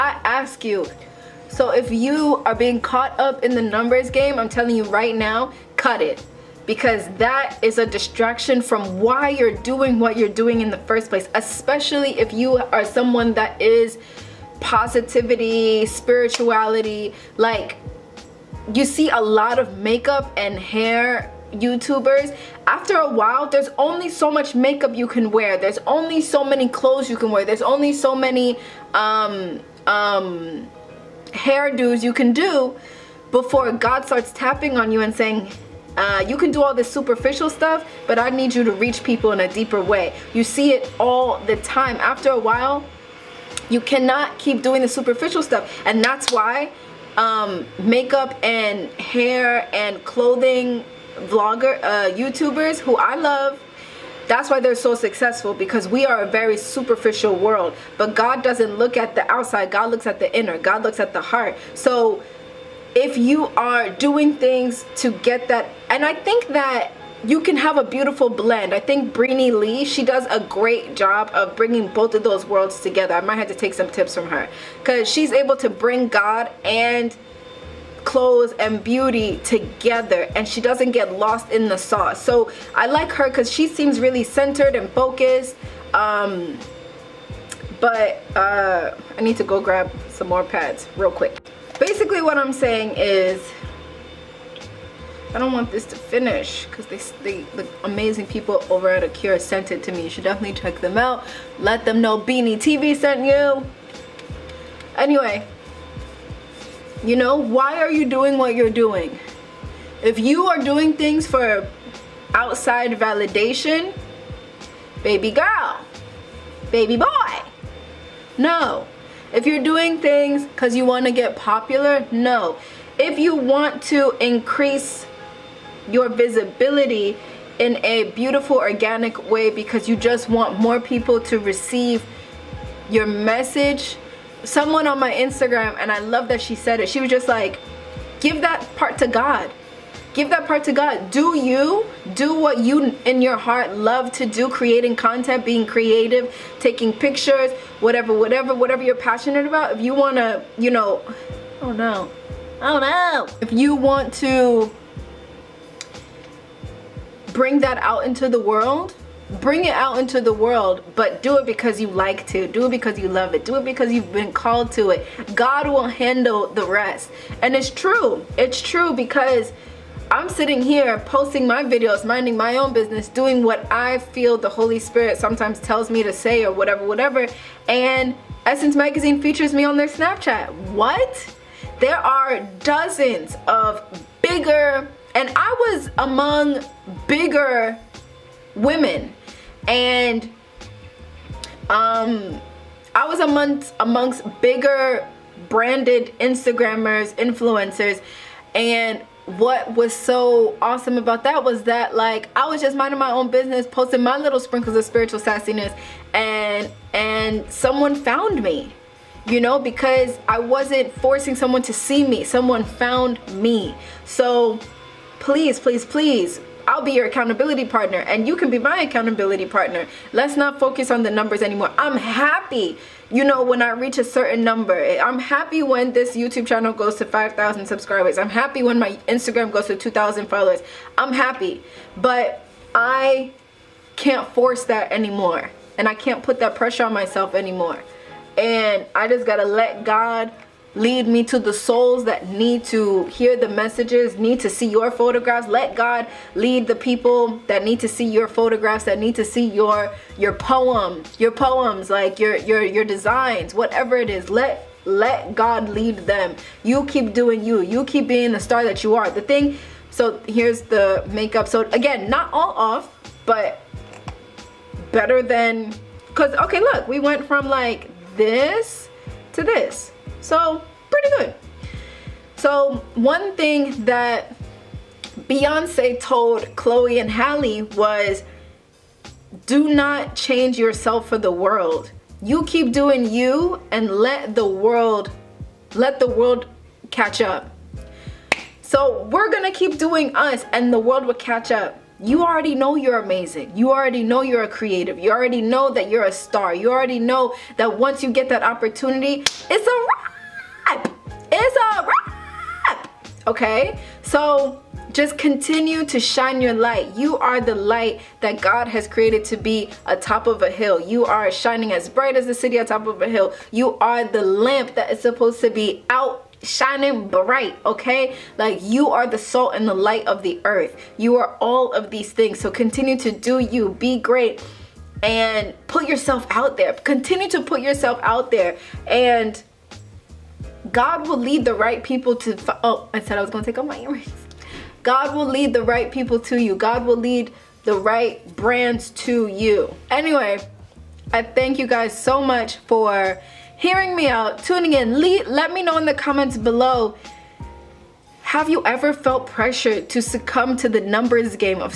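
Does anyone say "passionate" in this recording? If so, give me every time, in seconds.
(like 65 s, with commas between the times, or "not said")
148 s.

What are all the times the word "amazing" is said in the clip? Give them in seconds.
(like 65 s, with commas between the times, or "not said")
97 s, 292 s.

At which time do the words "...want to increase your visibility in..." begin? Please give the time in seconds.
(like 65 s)
123 s.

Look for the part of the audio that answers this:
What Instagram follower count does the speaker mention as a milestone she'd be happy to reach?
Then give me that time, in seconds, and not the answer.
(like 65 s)
229 s.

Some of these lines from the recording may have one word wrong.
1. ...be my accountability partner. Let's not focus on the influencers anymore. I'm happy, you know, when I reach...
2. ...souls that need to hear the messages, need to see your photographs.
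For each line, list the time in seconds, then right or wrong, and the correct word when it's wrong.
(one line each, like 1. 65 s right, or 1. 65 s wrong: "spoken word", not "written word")
1. 218 s wrong: "numbers", not "influencers"
2. 241 s right.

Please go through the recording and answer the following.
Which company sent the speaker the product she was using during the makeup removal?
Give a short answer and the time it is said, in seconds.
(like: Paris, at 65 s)
Acure, at 99 s.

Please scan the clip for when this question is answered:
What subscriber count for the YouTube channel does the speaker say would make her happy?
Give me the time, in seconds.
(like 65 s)
227 s.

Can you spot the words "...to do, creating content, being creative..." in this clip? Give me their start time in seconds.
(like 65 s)
144 s.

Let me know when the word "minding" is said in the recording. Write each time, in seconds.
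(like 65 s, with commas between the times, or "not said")
172 s, 202 s.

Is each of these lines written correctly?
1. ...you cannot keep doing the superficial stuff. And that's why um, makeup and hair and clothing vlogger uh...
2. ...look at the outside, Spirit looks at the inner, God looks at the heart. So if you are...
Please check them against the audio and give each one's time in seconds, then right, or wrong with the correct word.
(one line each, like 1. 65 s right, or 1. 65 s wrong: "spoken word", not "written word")
1. 43 s right
2. 58 s wrong: "God", not "Spirit".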